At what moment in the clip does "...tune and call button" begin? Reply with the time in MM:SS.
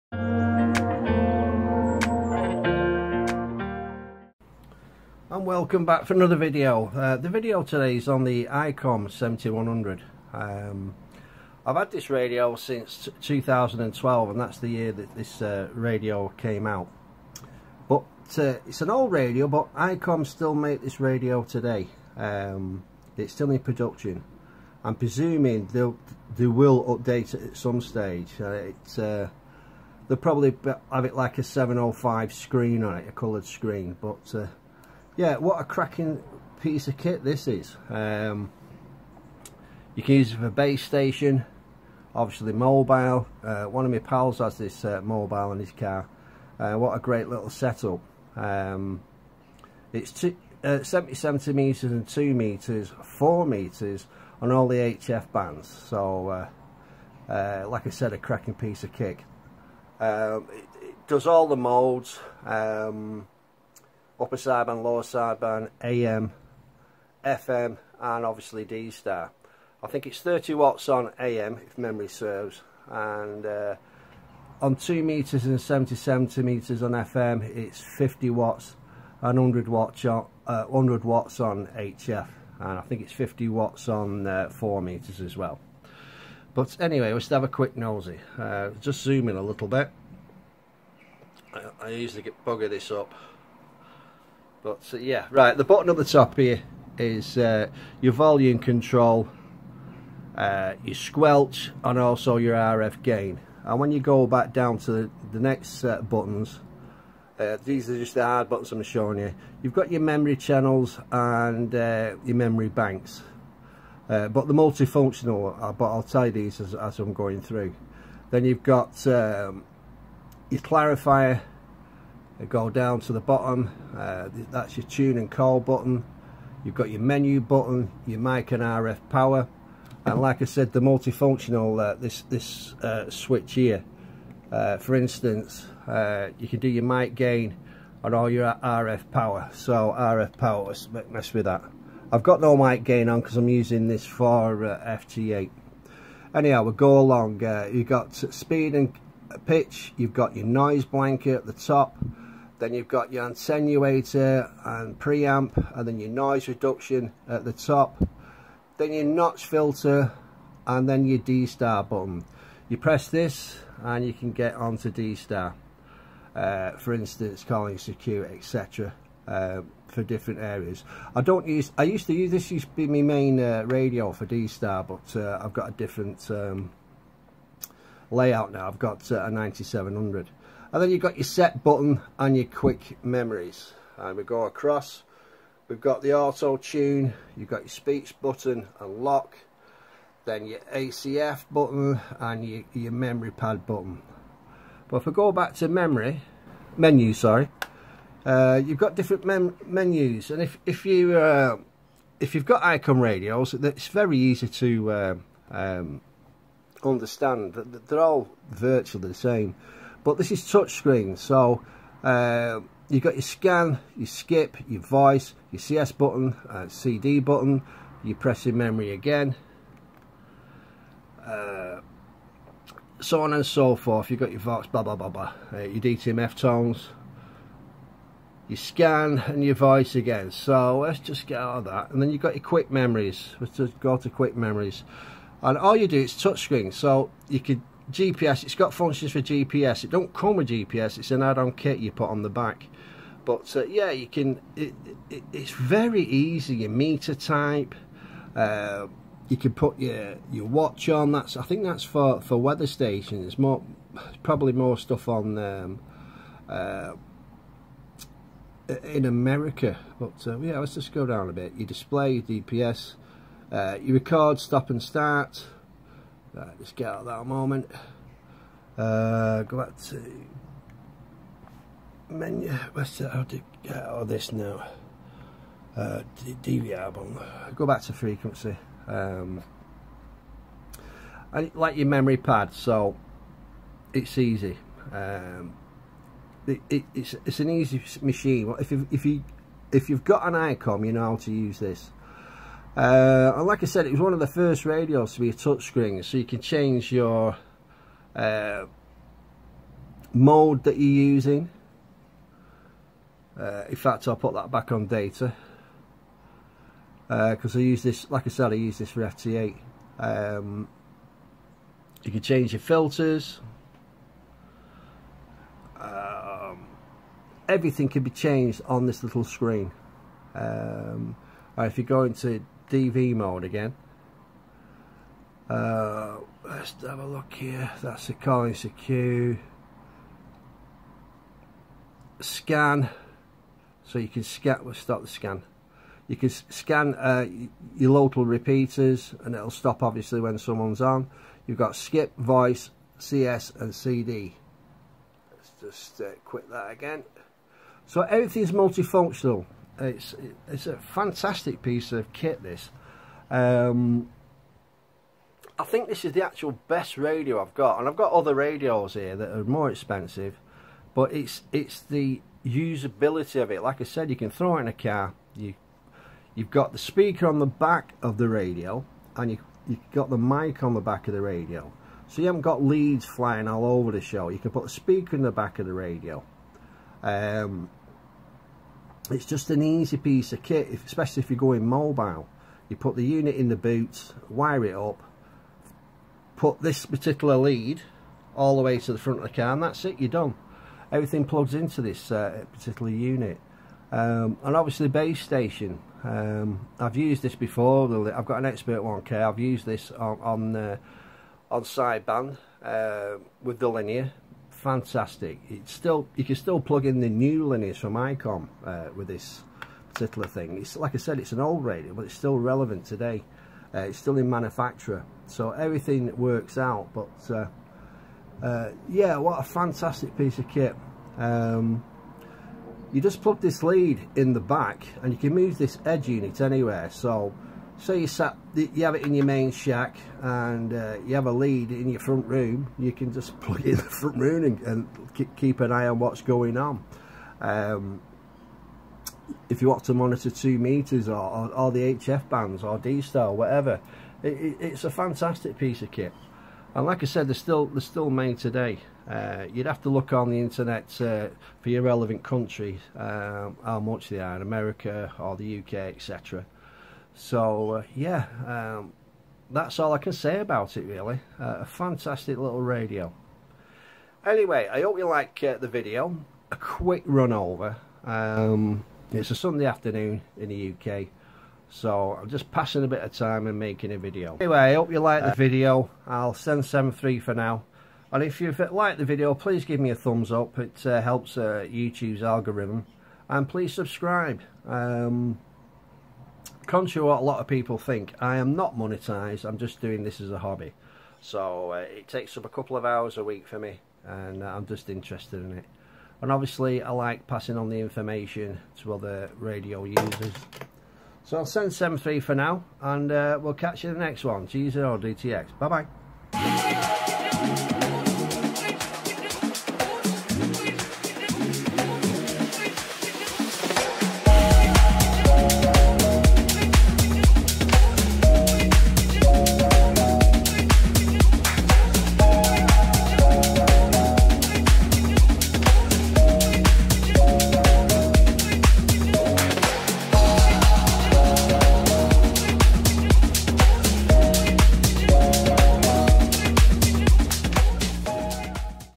02:04.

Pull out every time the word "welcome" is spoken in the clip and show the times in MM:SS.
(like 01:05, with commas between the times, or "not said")
00:05.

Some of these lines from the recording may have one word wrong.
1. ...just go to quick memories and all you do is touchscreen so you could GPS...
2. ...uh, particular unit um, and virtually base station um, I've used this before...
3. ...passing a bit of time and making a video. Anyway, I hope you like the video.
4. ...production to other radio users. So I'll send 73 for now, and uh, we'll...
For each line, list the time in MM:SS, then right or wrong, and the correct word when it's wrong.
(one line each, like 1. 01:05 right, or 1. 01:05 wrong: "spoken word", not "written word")
1. 03:53 right
2. 06:32 wrong: "obviously", not "virtually"
3. 07:52 right
4. 08:17 wrong: "information", not "production".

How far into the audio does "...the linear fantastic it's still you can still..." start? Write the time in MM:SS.
06:43.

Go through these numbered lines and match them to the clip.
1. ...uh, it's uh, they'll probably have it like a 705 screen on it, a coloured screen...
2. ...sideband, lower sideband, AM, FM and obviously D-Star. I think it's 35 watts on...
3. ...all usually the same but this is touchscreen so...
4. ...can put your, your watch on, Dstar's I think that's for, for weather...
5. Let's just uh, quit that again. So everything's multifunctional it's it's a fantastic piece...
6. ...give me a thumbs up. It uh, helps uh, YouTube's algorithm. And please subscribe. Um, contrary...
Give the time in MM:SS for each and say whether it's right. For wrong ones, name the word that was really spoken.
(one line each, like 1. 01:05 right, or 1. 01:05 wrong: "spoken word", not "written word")
1. 00:28 right
2. 01:04 wrong: "30", not "35"
3. 03:27 wrong: "virtually", not "usually"
4. 04:09 wrong: "That", not "Dstar"
5. 05:45 right
6. 07:59 right.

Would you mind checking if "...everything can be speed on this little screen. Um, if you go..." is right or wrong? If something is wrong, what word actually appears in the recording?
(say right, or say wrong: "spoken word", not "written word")
wrong: "changed", not "speed".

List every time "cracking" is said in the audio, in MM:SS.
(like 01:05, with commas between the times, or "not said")
00:35, 00:58.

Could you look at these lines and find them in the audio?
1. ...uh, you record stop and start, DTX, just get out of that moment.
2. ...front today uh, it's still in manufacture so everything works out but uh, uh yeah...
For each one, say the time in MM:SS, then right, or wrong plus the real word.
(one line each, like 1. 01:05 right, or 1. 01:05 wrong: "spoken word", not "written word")
1. 04:23 wrong: "Right", not "DTX"
2. 06:52 wrong: "relevant", not "front".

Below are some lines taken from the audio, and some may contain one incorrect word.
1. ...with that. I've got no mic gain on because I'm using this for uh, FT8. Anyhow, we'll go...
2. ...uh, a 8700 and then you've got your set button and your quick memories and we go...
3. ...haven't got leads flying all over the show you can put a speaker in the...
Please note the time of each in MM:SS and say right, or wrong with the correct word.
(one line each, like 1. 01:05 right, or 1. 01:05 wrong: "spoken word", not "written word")
1. 02:21 right
2. 02:59 wrong: "9700", not "8700"
3. 06:12 right.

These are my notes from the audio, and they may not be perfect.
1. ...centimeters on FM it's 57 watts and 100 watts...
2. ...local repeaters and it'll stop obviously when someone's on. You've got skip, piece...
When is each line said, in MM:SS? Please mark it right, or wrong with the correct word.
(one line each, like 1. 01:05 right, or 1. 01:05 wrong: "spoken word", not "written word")
1. 01:15 wrong: "50", not "57"
2. 05:37 wrong: "voice", not "piece".